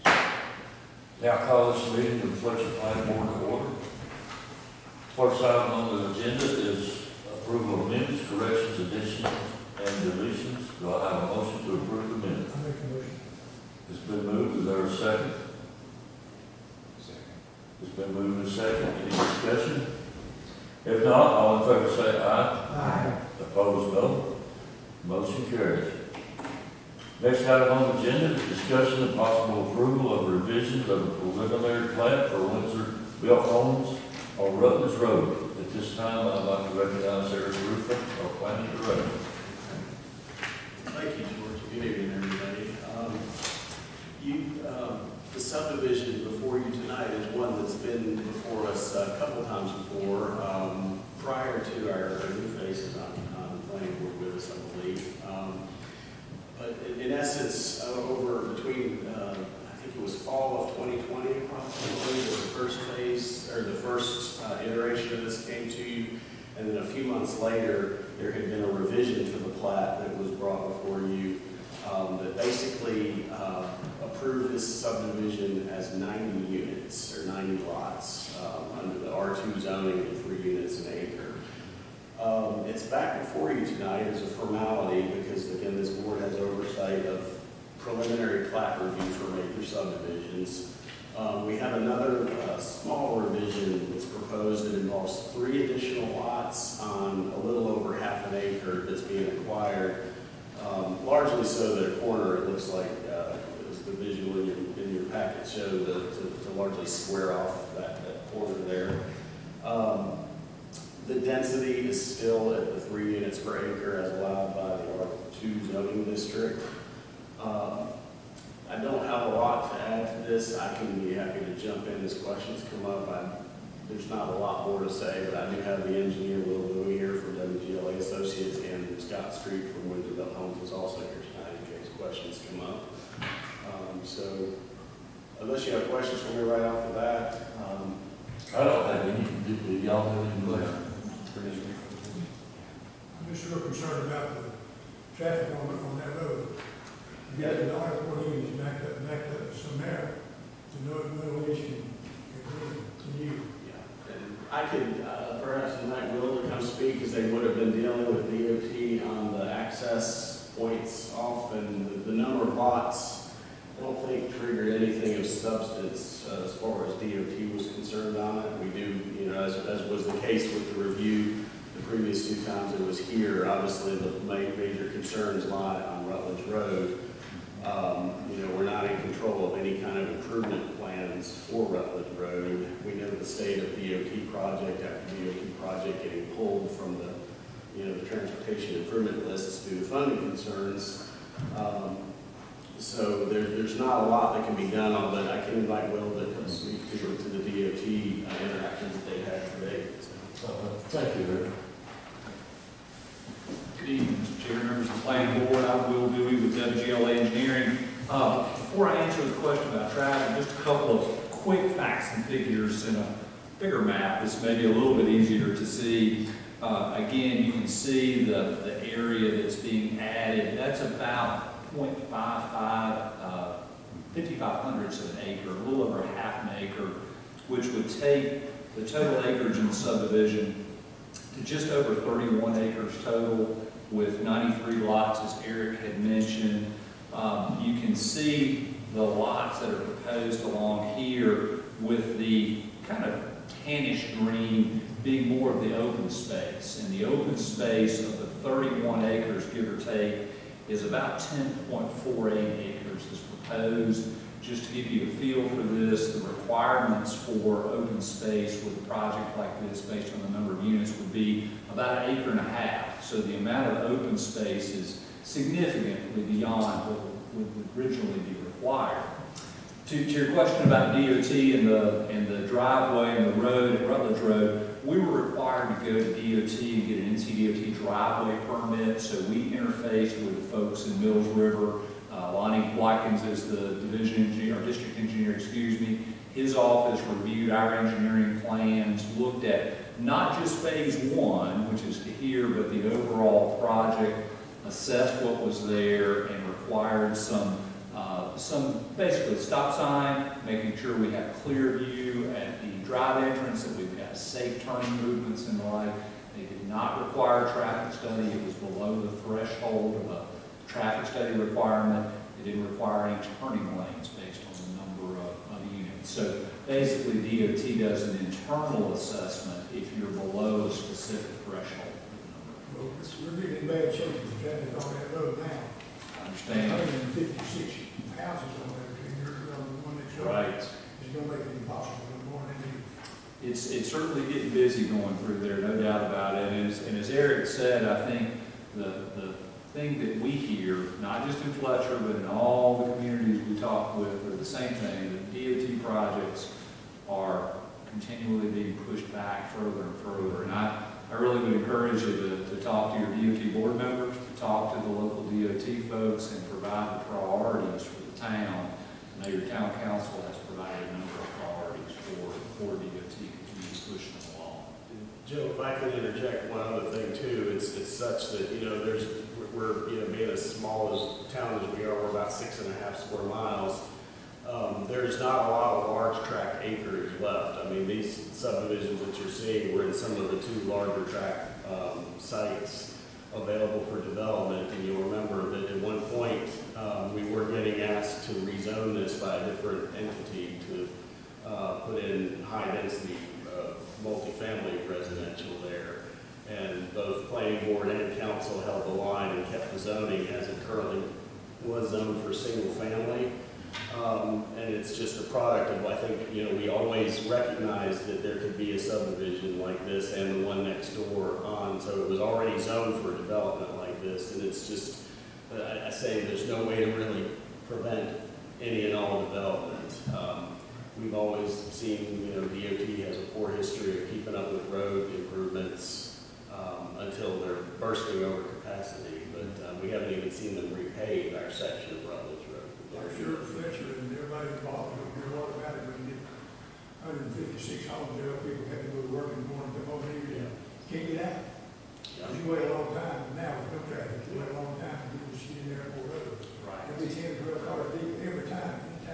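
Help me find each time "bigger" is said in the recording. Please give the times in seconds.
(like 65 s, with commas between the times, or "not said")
213 s.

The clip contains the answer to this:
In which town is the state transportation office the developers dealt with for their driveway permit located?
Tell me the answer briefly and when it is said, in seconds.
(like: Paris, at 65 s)
Mills River, at 281 s.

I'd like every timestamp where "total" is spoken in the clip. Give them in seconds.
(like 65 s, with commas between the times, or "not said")
228 s, 233 s.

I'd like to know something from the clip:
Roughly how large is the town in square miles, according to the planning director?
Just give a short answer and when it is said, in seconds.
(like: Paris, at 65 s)
6.5 square miles, at 372 s.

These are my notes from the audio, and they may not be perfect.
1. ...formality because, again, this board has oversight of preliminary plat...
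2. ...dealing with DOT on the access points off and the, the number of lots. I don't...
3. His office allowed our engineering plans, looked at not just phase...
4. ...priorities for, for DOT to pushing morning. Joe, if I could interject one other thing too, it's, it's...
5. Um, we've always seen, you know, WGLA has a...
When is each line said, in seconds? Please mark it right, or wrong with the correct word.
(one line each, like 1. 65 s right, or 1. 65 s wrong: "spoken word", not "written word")
1. 84 s right
2. 157 s right
3. 286 s wrong: "reviewed", not "allowed"
4. 361 s wrong: "along", not "morning"
5. 420 s wrong: "DOT", not "WGLA".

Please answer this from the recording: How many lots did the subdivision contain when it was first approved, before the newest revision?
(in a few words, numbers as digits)
90.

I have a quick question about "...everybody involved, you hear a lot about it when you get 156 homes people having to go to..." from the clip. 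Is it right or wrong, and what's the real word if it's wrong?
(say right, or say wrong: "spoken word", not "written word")
right.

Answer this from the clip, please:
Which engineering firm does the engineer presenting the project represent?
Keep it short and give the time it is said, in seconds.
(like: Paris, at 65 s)
WGLA Associates, at 127 s.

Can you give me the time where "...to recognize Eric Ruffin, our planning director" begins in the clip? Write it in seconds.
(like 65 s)
36 s.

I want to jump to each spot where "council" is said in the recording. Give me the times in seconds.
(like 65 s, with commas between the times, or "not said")
359 s, 398 s.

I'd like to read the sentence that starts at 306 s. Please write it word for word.
They did not require a traffic study.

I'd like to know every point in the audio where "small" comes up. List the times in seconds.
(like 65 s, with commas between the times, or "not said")
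92 s, 370 s.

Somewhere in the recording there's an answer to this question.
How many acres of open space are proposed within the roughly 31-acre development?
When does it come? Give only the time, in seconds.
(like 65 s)
251 s.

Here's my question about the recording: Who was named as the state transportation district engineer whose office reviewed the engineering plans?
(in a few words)
Lonnie Watkins.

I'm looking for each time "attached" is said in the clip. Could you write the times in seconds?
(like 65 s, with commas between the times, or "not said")
not said.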